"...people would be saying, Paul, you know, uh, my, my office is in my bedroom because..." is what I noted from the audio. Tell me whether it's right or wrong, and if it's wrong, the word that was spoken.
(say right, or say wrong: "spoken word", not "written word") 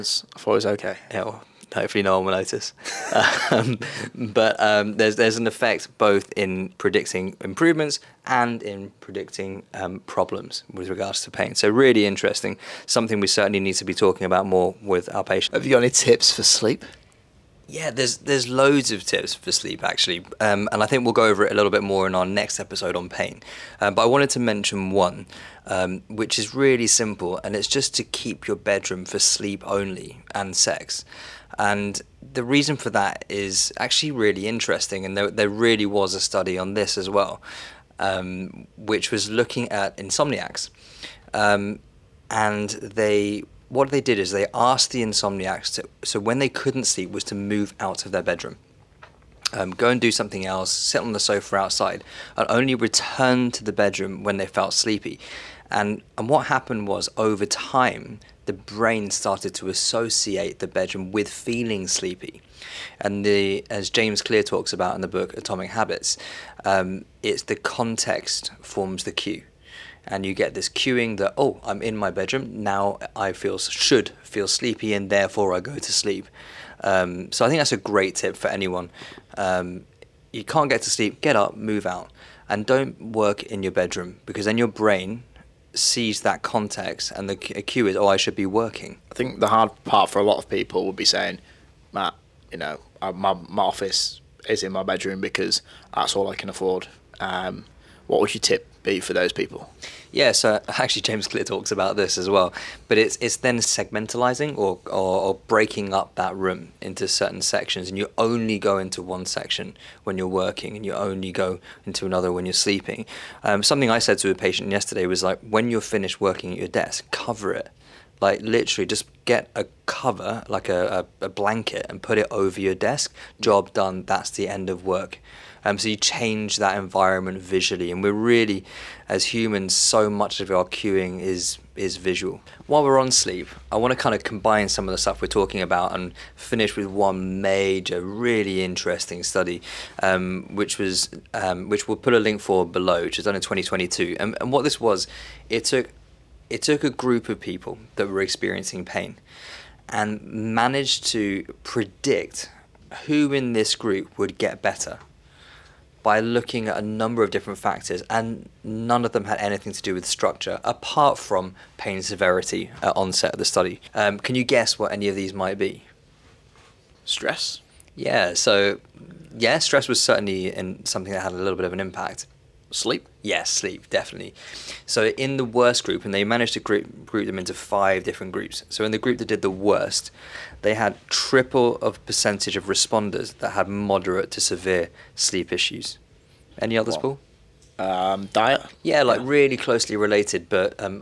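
wrong: "Matt", not "Paul".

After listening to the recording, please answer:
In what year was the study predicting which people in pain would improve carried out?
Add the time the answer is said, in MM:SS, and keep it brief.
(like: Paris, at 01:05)
2022, at 02:23.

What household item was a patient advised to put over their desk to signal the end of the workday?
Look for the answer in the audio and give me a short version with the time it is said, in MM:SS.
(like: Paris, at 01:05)
a blanket, at 02:01.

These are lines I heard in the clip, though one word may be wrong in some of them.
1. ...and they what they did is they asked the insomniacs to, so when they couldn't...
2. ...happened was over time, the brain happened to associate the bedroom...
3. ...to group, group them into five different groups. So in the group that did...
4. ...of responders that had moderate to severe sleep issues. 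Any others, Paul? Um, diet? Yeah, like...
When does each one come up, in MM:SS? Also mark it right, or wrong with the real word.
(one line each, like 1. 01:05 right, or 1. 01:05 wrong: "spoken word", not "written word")
1. 00:42 right
2. 00:56 wrong: "started", not "happened"
3. 02:56 right
4. 03:02 right.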